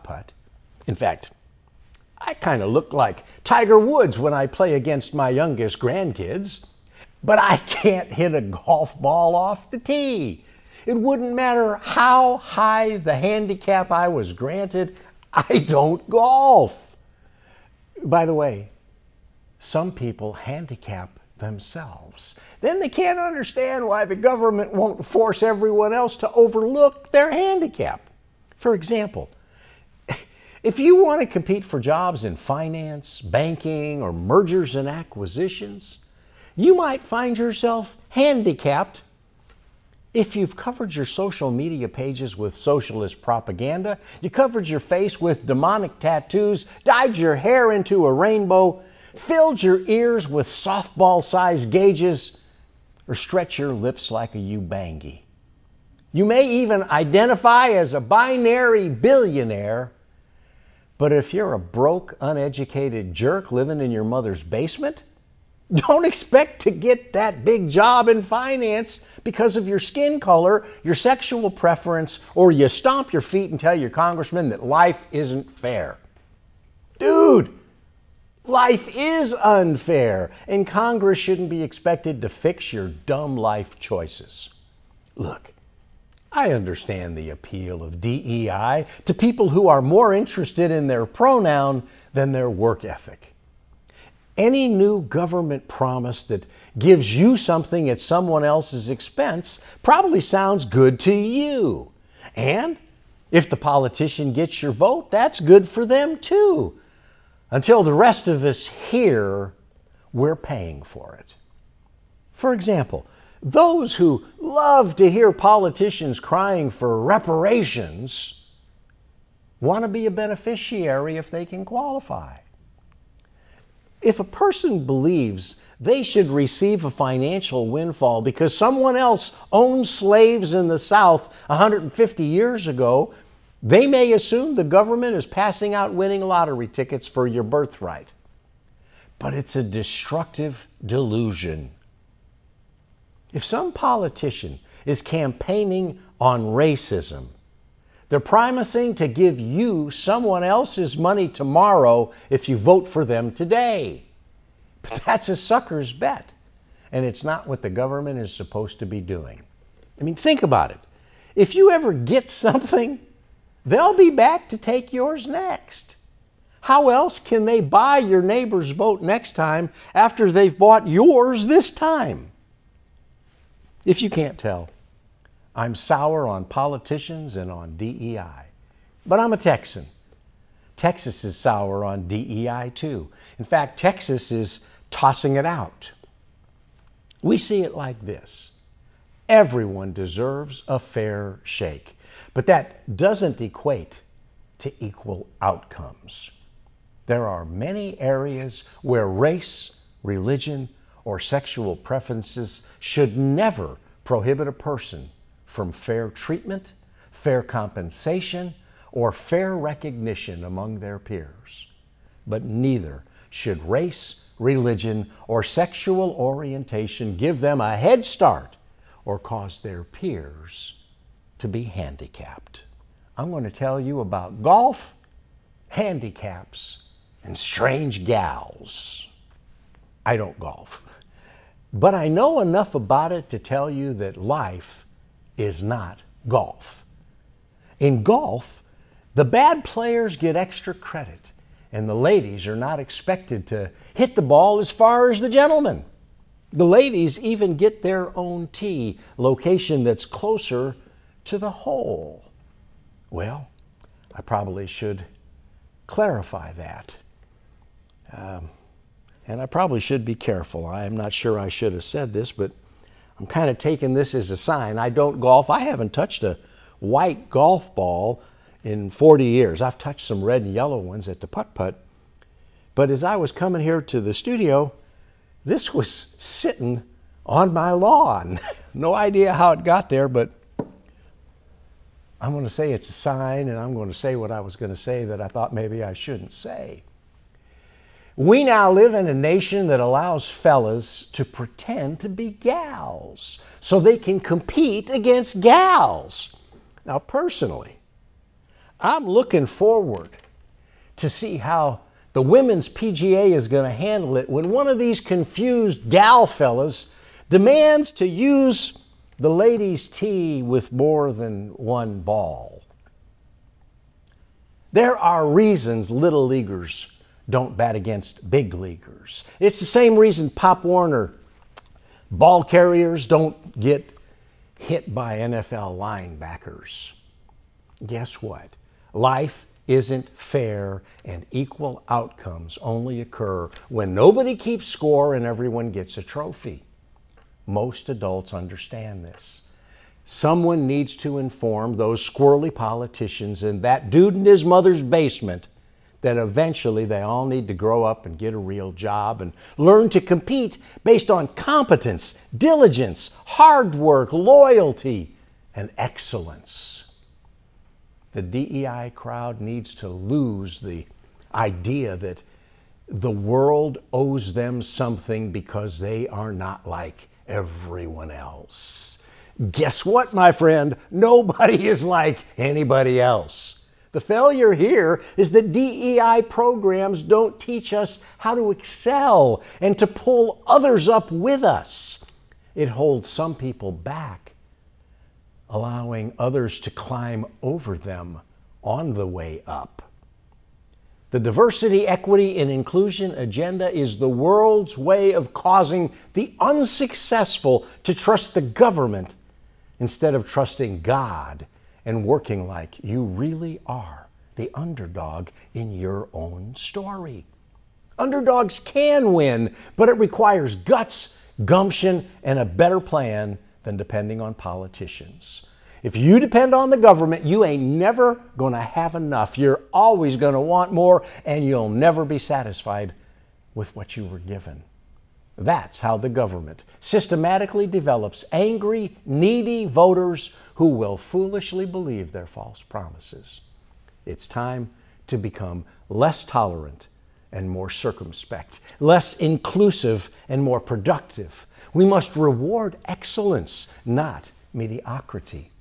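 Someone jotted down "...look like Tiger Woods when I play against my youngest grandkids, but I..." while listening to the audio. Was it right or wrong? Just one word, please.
right.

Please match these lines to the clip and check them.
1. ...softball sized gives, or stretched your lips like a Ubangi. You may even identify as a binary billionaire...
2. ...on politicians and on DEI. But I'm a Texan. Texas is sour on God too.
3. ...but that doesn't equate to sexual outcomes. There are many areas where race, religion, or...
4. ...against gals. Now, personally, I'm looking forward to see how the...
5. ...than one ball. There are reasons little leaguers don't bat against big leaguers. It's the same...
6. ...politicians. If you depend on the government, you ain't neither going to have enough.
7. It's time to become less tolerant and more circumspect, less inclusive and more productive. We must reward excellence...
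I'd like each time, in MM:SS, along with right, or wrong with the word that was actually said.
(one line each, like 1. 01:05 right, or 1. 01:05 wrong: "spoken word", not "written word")
1. 00:50 wrong: "gauges", not "gives"
2. 02:56 wrong: "DEI", not "God"
3. 03:12 wrong: "equal", not "sexual"
4. 04:54 right
5. 05:11 right
6. 06:54 wrong: "never", not "neither"
7. 07:14 right.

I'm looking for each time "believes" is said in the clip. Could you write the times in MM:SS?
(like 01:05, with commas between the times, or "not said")
02:04, 07:11.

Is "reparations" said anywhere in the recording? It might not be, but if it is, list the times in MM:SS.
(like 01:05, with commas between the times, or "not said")
01:56.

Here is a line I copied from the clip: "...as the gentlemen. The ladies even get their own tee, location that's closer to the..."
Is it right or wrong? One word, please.
right.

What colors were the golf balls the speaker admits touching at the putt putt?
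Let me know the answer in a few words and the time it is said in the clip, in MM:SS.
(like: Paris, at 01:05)
red and yellow, at 04:30.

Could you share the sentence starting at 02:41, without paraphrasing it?
If you ever get something, they'll be back to take yours next.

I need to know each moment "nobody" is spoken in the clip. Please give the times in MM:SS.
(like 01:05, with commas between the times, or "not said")
05:33, 06:10.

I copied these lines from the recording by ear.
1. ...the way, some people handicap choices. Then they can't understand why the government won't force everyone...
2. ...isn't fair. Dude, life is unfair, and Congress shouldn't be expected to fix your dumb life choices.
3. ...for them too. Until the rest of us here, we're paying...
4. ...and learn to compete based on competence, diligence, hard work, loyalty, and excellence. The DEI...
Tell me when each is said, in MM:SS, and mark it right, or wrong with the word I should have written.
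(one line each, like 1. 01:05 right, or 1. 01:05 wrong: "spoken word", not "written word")
1. 00:18 wrong: "themselves", not "choices"
2. 01:15 right
3. 01:45 right
4. 05:49 right.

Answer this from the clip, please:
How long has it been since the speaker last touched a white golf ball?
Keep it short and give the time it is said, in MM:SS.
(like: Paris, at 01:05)
40 years, at 04:28.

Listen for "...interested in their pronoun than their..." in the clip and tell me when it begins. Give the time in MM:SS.
01:30.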